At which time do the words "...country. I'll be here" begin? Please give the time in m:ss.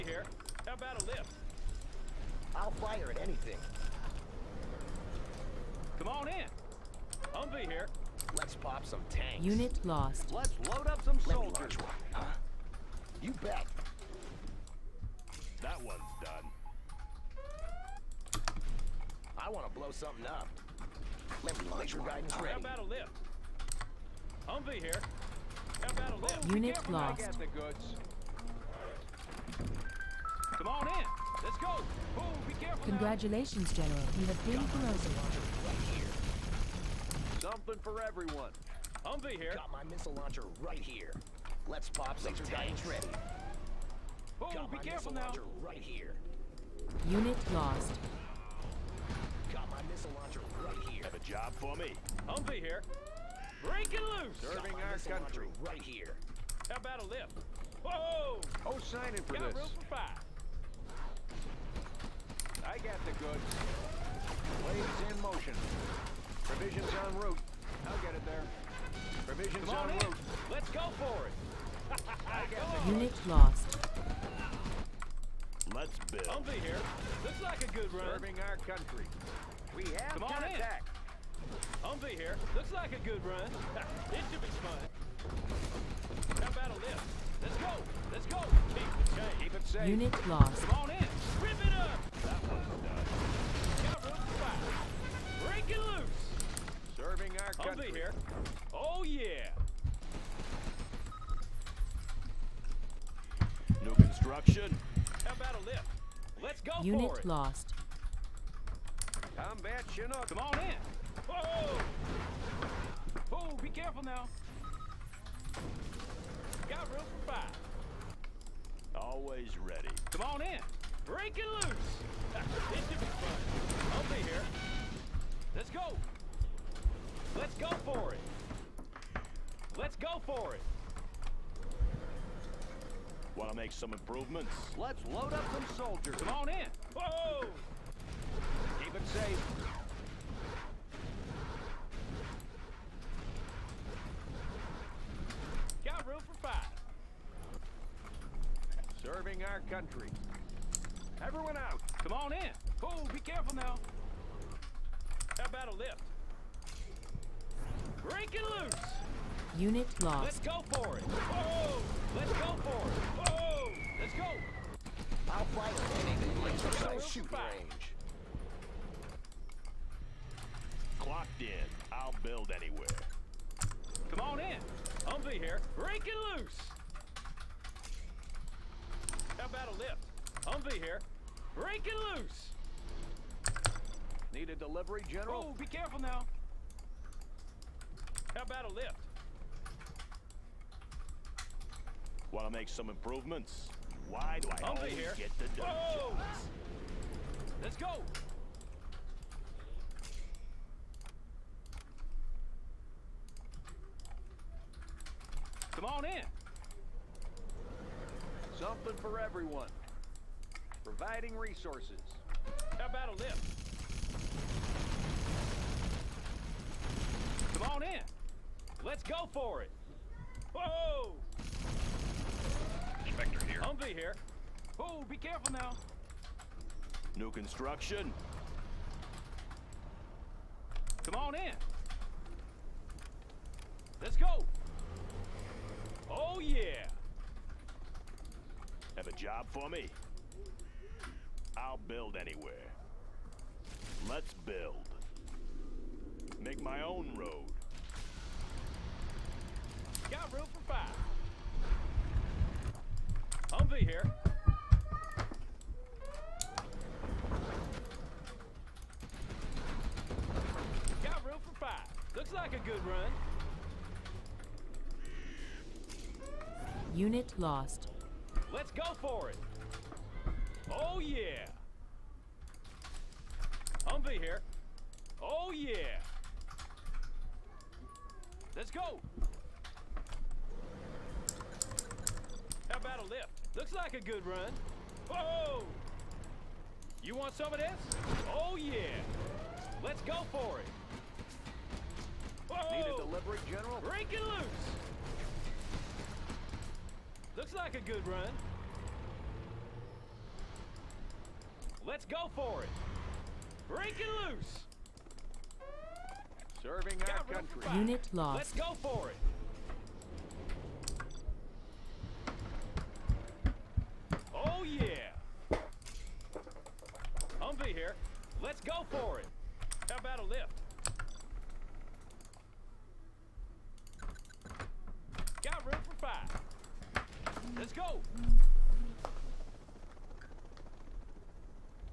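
1:37.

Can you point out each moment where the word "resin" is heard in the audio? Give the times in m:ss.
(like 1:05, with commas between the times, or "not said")
not said.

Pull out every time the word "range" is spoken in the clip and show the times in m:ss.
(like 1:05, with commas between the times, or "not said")
2:47.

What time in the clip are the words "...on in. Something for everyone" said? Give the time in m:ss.
3:25.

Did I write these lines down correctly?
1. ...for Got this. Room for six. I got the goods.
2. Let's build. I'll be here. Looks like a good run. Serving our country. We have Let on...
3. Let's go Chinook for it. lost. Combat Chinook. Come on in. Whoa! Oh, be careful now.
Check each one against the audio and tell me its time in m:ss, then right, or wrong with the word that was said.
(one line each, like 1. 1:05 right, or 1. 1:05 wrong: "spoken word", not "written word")
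1. 0:59 wrong: "five", not "six"
2. 1:15 wrong: "Come", not "Let"
3. 1:46 wrong: "Unit", not "Chinook".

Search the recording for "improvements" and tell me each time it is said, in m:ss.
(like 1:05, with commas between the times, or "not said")
2:13, 3:12.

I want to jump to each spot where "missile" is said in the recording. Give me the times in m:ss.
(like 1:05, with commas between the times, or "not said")
0:39, 0:49.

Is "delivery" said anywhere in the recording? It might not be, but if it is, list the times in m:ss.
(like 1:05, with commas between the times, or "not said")
3:04, 4:52.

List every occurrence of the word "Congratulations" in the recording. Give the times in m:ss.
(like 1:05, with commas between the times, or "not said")
0:32.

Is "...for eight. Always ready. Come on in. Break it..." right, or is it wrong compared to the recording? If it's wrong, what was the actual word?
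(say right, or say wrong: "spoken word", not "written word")
wrong: "five", not "eight".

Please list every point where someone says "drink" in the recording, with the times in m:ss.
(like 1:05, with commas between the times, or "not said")
not said.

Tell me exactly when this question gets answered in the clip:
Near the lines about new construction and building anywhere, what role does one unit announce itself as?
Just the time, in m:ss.
3:43.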